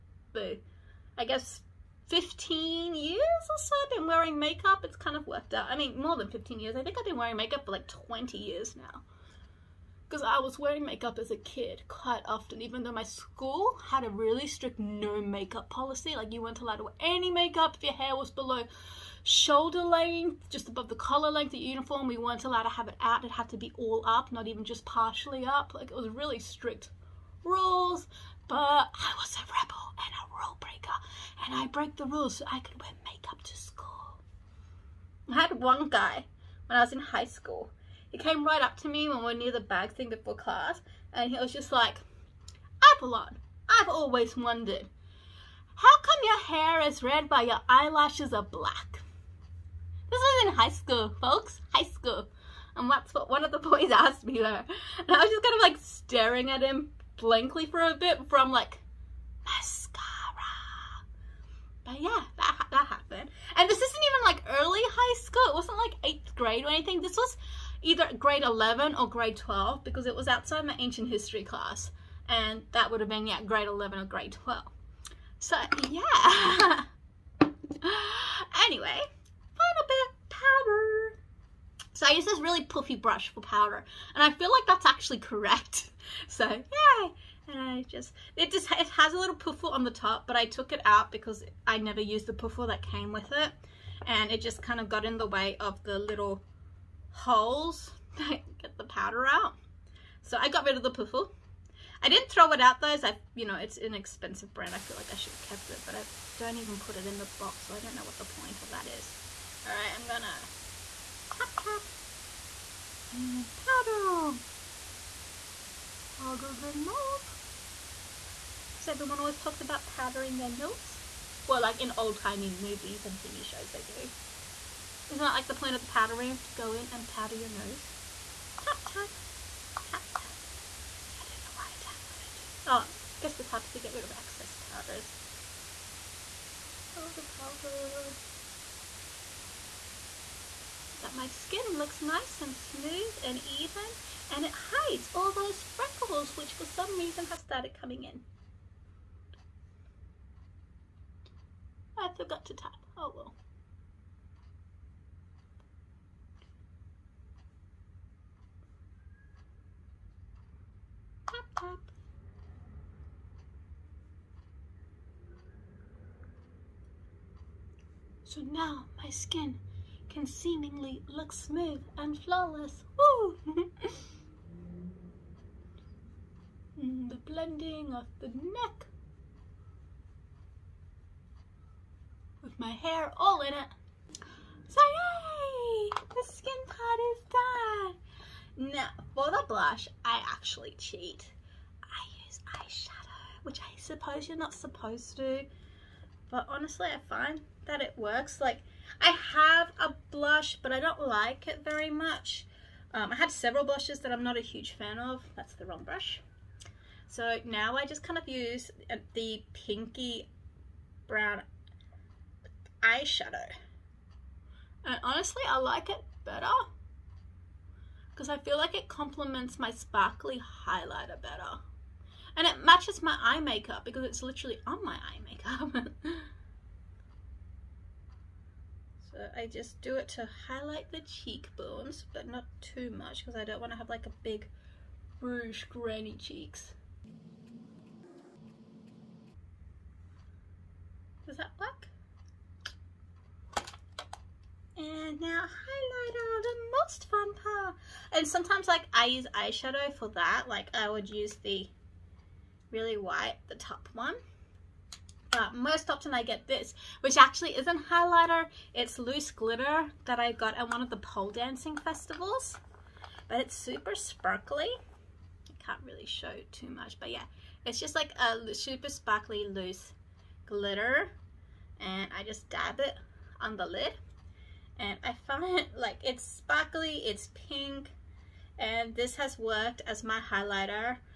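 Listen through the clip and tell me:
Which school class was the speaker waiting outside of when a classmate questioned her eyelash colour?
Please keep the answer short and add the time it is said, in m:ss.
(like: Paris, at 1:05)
Ancient history, at 1:10.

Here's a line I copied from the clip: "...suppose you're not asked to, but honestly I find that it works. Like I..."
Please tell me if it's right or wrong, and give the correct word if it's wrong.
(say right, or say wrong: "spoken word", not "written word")
wrong: "supposed", not "asked".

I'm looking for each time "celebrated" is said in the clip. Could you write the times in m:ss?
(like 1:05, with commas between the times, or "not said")
not said.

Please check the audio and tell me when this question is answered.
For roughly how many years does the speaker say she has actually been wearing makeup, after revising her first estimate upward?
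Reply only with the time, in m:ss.
0:07.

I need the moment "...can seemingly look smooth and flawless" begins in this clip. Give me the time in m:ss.
2:50.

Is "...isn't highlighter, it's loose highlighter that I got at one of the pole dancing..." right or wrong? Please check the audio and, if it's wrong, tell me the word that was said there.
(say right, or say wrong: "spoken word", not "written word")
wrong: "glitter", not "highlighter".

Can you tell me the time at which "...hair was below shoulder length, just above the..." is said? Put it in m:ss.
0:17.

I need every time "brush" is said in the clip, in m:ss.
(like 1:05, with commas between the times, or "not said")
1:22, 3:25.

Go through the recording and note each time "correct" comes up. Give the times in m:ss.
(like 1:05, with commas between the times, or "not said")
1:25.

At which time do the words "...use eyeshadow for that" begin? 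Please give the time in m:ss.
4:09.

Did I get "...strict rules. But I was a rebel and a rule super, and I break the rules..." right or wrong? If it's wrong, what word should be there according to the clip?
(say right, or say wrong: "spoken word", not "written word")
wrong: "breaker", not "super".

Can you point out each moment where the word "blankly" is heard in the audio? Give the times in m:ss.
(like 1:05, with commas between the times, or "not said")
0:57.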